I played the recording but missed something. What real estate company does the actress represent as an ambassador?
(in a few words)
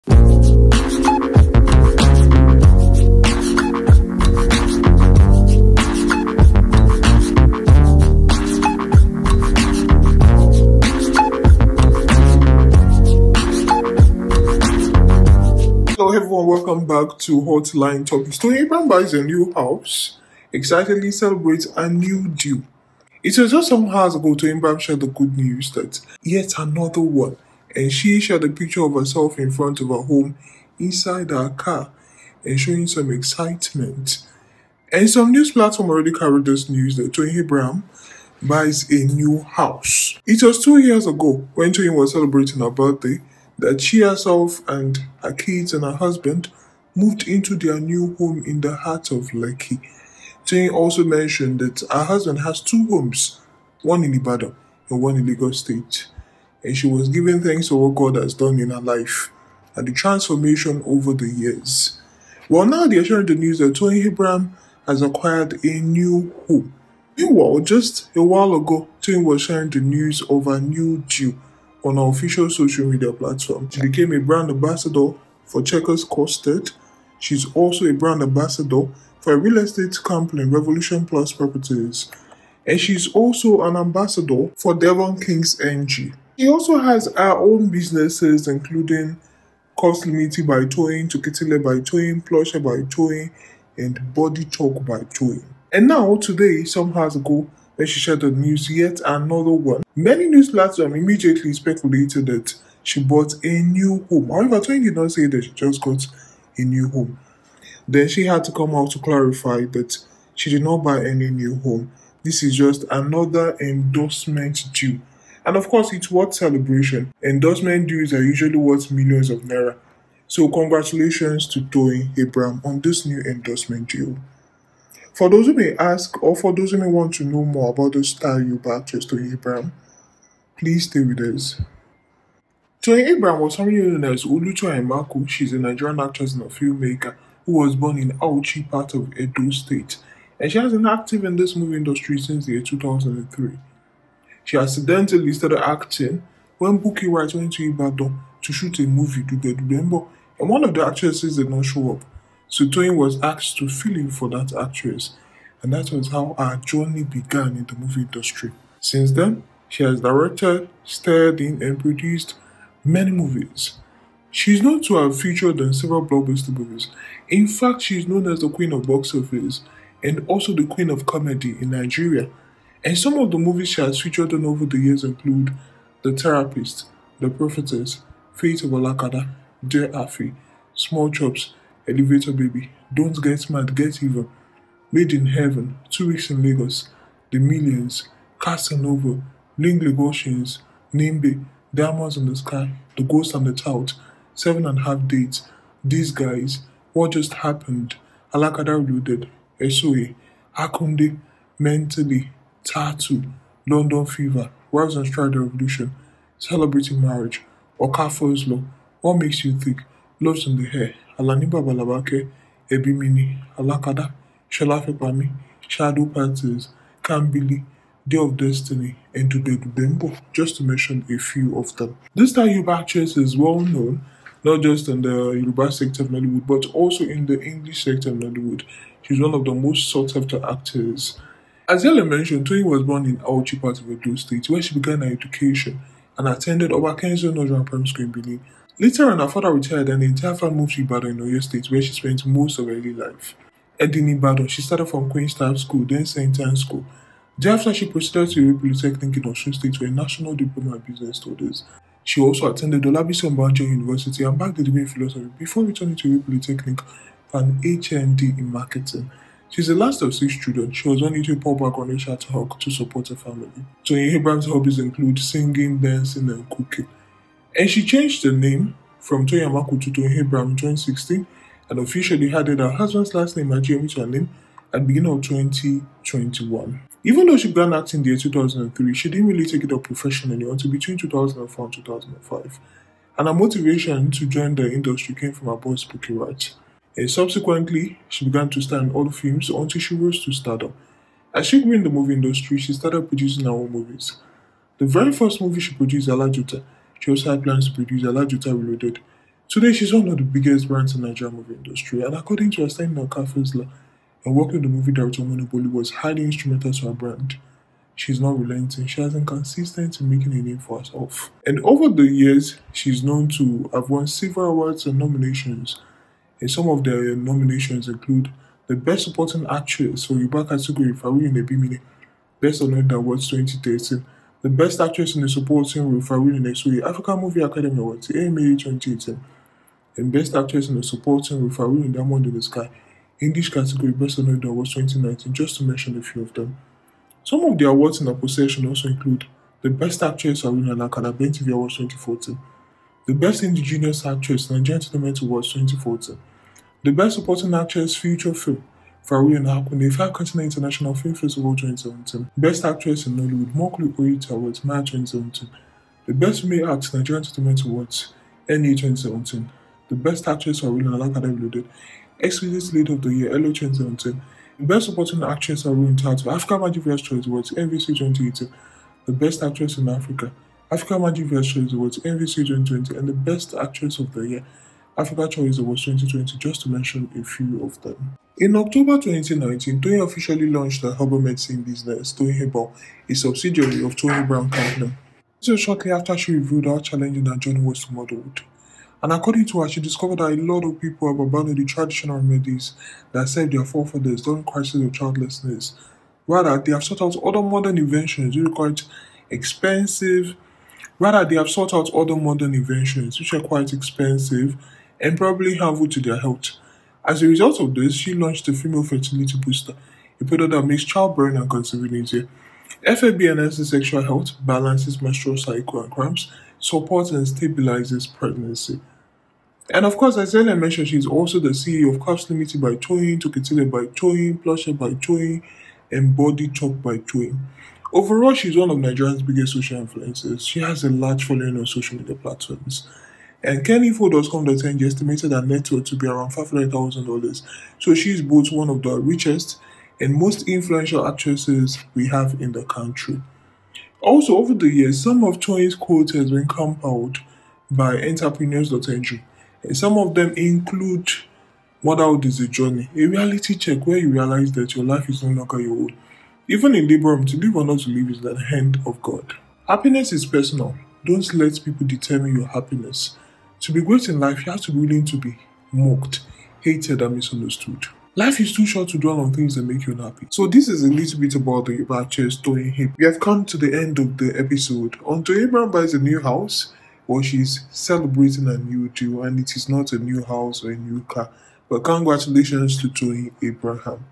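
Revolution Plus Properties.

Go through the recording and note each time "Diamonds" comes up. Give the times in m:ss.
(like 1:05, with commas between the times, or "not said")
3:11, 5:31.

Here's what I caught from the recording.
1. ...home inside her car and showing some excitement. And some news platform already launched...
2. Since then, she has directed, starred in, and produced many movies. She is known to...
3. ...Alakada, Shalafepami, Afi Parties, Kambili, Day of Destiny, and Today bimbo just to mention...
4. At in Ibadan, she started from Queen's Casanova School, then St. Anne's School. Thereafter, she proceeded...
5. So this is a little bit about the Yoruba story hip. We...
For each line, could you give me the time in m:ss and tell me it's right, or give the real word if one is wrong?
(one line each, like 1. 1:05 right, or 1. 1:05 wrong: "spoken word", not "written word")
1. 0:30 wrong: "carried", not "launched"
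2. 2:38 right
3. 3:33 wrong: "Shadow", not "Afi"
4. 4:03 wrong: "Staff", not "Casanova"
5. 7:50 wrong: "Ibache", not "Yoruba".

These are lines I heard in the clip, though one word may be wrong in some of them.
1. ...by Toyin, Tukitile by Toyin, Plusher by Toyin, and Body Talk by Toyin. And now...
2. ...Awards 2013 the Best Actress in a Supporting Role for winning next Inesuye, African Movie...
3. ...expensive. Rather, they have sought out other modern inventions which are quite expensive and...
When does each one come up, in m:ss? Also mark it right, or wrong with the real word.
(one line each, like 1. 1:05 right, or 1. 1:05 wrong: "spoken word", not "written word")
1. 1:30 right
2. 5:22 right
3. 6:39 right.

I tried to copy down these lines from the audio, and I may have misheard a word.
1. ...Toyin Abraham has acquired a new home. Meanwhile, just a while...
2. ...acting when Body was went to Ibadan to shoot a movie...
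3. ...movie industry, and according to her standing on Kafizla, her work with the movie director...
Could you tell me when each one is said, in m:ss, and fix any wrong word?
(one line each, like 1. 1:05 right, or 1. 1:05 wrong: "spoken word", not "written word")
1. 1:03 right
2. 2:25 wrong: "Bukky", not "Body"
3. 5:01 right.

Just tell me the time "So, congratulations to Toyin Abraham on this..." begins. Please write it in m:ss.
2:00.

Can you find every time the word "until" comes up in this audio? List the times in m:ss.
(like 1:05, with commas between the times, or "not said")
4:40, 4:49, 7:55.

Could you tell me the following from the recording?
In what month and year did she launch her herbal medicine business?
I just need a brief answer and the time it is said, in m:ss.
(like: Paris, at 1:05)
October 2019, at 6:18.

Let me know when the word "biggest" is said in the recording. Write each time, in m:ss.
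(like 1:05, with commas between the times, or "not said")
5:00, 7:09.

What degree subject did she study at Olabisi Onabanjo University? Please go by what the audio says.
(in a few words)
Philosophy.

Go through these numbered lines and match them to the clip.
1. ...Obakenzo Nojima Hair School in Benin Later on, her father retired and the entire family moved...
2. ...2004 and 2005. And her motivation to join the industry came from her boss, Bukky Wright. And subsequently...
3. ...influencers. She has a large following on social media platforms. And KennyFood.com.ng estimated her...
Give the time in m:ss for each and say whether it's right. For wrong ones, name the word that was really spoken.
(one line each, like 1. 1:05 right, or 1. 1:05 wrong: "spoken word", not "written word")
1. 3:56 wrong: "Primary", not "Hair"
2. 4:40 right
3. 7:09 right.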